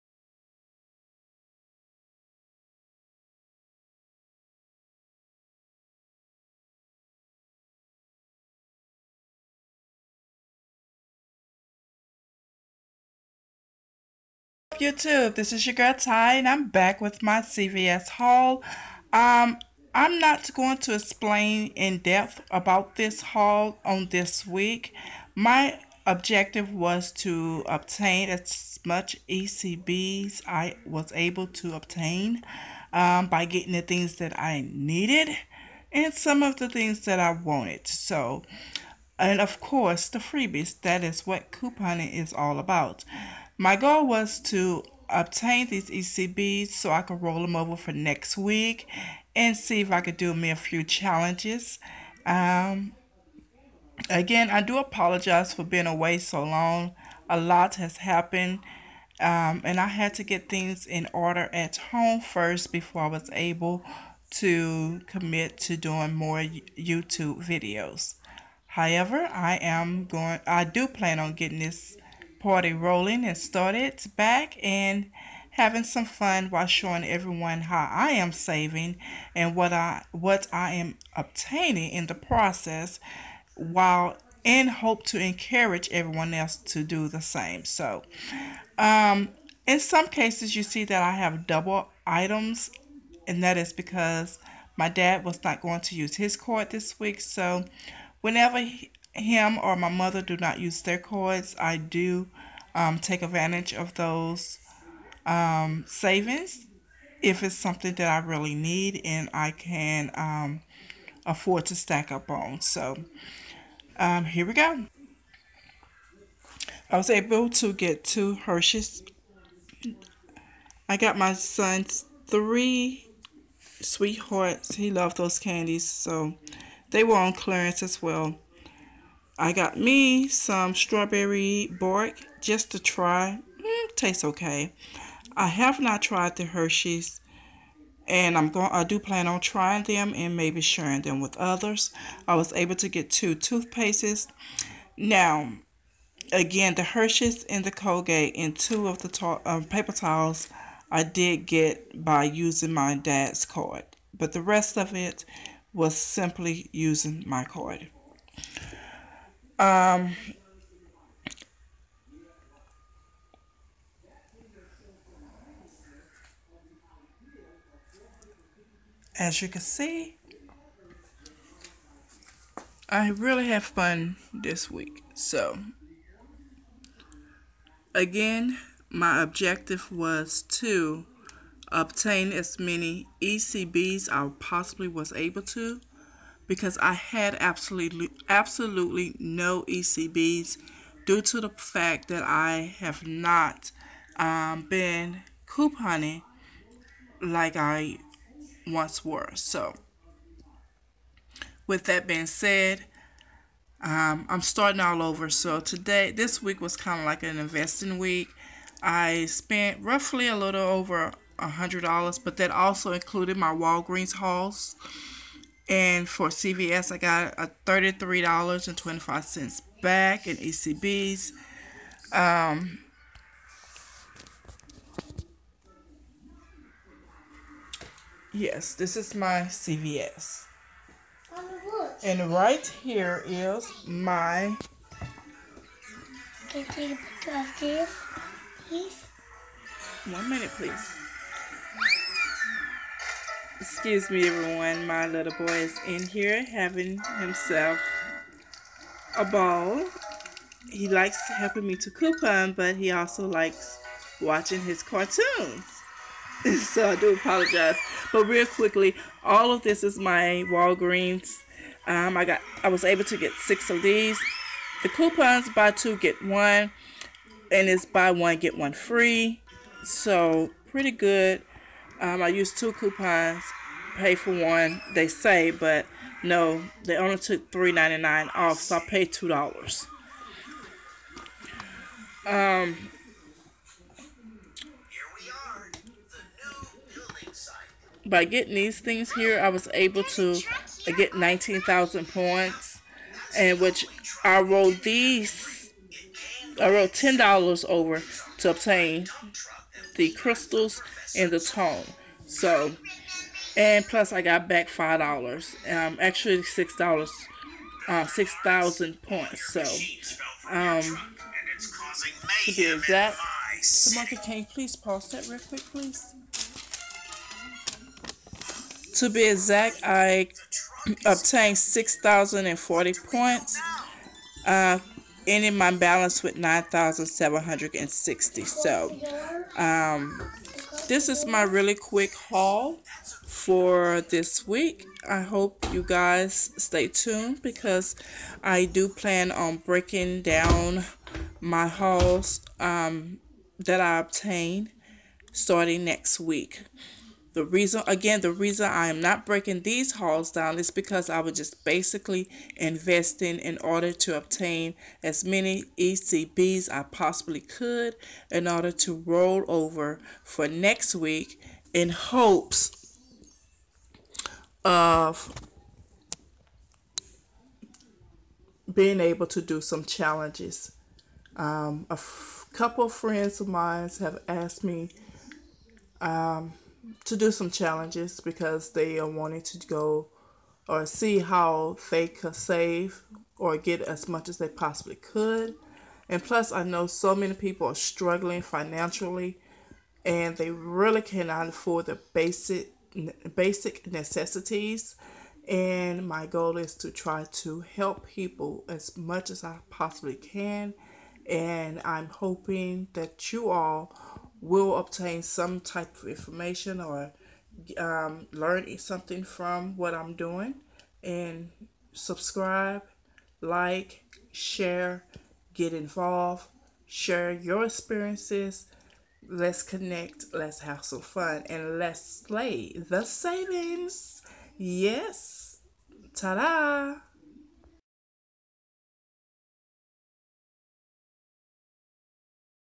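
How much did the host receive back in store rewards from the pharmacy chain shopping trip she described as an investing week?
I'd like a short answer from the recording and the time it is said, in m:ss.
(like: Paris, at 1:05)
$33.25, at 3:37.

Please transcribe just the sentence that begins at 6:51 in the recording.
And subscribe, like, share, get involved, share your experiences.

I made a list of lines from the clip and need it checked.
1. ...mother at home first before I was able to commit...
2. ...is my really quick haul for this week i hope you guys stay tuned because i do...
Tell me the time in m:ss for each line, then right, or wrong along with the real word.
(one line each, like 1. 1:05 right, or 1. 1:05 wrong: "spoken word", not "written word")
1. 1:01 wrong: "order", not "mother"
2. 5:31 right.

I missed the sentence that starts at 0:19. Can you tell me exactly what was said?
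Um, I'm not going to explain in depth about this haul on this week.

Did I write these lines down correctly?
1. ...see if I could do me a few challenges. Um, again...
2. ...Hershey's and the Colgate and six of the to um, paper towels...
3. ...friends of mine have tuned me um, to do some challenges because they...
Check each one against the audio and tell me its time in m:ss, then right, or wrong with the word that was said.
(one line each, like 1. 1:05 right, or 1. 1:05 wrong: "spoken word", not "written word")
1. 0:49 right
2. 2:26 wrong: "two", not "six"
3. 6:12 wrong: "asked", not "tuned".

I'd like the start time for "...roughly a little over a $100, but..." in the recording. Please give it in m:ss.
3:29.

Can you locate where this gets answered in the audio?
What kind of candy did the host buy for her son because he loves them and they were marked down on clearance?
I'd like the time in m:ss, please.
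2:03.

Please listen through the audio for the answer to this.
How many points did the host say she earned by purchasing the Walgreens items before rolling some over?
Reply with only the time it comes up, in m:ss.
4:51.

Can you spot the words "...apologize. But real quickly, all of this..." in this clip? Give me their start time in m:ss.
4:17.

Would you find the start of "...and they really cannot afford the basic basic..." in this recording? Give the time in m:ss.
6:30.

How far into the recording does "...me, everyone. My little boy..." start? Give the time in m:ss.
4:04.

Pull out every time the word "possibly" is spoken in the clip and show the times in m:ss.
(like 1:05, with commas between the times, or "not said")
3:04, 5:56, 6:24, 6:39.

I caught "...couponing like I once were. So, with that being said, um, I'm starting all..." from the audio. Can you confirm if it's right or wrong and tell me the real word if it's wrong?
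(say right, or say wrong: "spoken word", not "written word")
right.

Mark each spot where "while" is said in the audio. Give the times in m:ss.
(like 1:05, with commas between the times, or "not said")
1:16, 1:23.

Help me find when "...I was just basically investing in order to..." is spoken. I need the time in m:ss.
5:51.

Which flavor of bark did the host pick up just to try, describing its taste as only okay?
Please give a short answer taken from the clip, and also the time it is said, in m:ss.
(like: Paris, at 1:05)
Strawberry, at 2:10.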